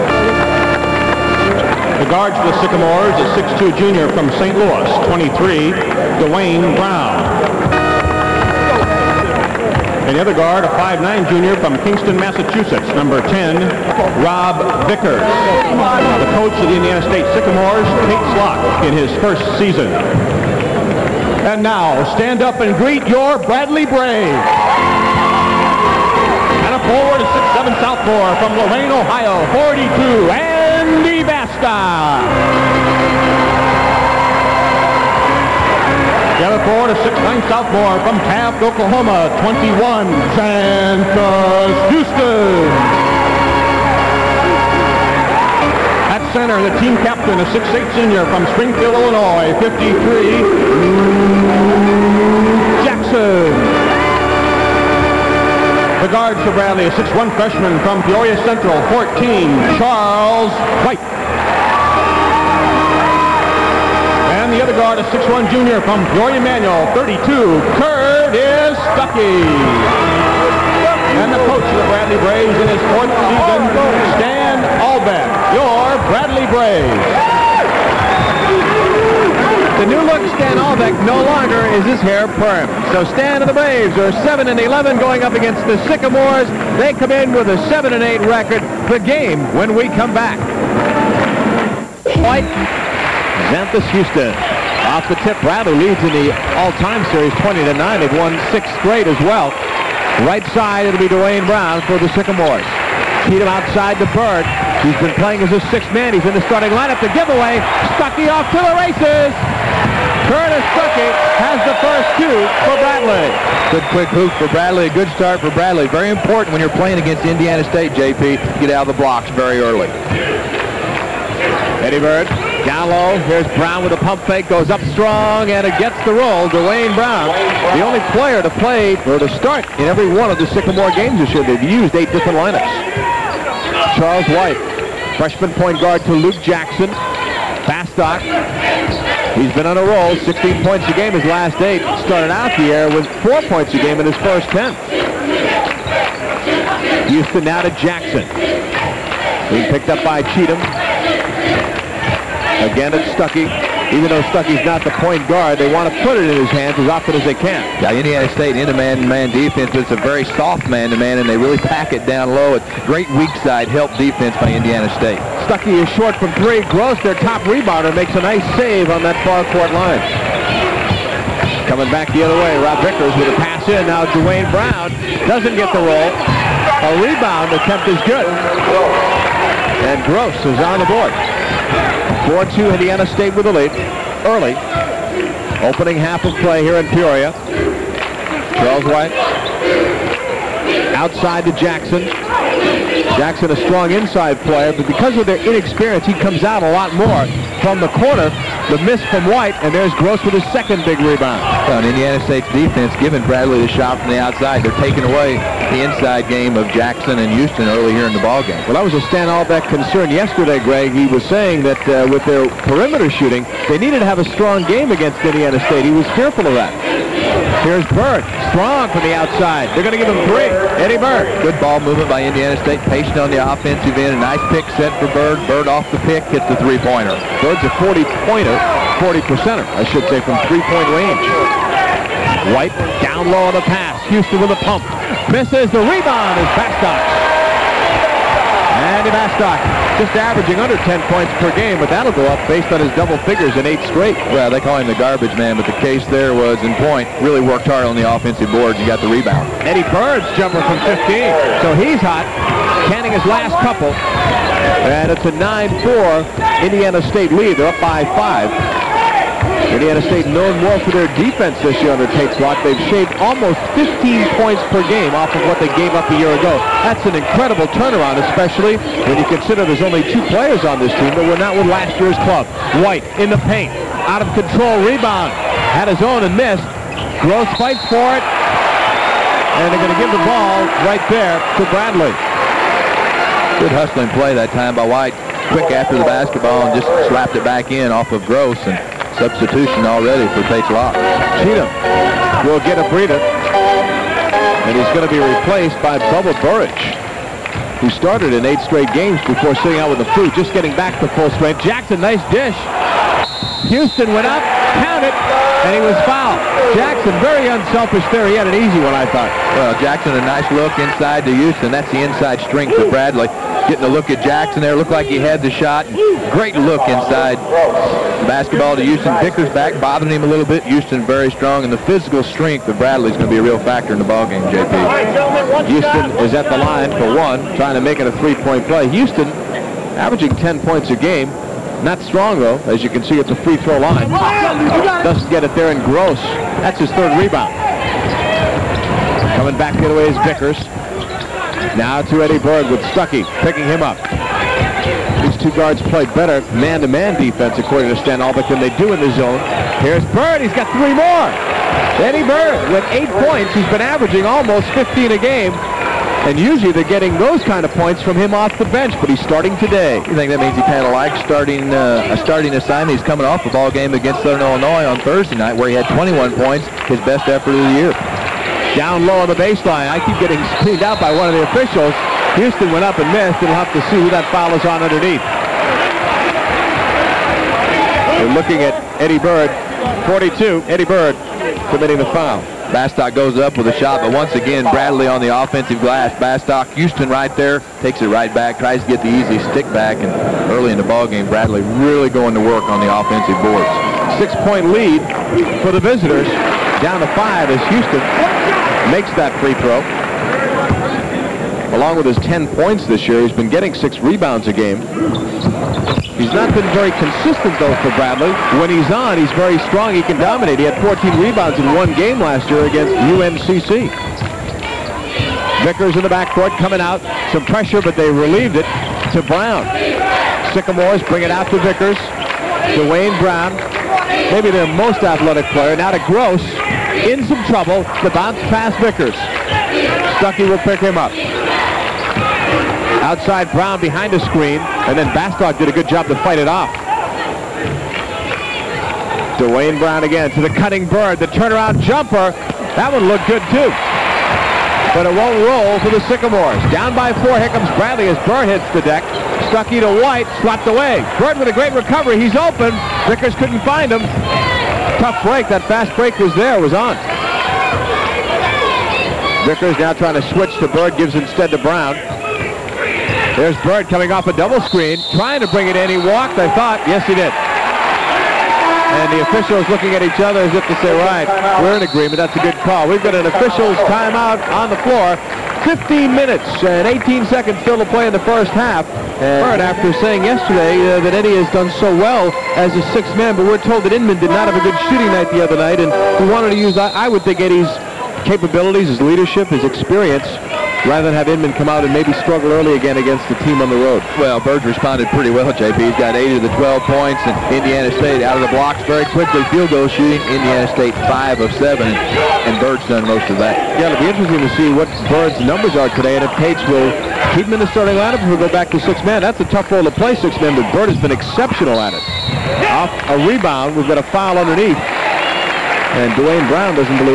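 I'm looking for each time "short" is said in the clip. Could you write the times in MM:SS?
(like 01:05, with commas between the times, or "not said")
02:45.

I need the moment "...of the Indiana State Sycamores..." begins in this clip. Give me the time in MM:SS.
00:16.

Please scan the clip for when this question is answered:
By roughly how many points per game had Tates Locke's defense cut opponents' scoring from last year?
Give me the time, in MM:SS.
04:23.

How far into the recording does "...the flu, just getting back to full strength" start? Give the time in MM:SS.
04:59.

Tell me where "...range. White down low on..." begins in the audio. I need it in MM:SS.
03:50.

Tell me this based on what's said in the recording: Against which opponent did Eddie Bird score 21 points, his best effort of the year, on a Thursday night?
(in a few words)
Southern Illinois.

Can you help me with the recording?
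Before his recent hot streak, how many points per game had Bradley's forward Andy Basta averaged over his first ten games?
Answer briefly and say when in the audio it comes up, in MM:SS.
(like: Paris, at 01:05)
4, at 02:23.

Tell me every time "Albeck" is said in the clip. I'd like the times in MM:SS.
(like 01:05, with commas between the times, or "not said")
01:20, 03:29, 05:48.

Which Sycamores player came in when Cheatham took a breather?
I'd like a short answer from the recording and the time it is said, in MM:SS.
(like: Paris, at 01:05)
Bubba Burridge, at 04:56.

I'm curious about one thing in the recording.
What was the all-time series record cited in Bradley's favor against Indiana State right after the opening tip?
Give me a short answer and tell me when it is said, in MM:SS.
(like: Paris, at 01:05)
20 to 9, at 01:37.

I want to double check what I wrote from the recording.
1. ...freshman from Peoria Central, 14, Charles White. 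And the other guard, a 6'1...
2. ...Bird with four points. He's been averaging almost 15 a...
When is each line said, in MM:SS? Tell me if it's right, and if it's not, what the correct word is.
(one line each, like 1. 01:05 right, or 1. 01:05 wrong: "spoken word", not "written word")
1. 00:57 right
2. 05:52 wrong: "eight", not "four".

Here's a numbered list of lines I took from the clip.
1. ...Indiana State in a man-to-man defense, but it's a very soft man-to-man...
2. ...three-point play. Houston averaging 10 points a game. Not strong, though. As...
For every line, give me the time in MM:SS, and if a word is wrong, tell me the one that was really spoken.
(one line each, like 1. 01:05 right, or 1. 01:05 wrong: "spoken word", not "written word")
1. 02:37 right
2. 05:28 right.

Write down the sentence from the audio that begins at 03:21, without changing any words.
Well, and Indiana State's defense giving Bradley the shot from the outside.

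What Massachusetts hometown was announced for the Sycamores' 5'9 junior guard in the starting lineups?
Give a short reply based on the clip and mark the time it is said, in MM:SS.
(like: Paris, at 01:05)
Kingston, at 00:11.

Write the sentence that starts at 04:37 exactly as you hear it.
Gross fights for it, and they're going to give the ball right there to Bradley.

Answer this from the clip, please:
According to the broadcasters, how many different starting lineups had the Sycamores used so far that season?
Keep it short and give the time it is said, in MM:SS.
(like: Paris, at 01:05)
8, at 02:11.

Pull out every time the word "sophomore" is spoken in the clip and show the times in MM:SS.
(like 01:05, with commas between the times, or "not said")
00:27, 00:37.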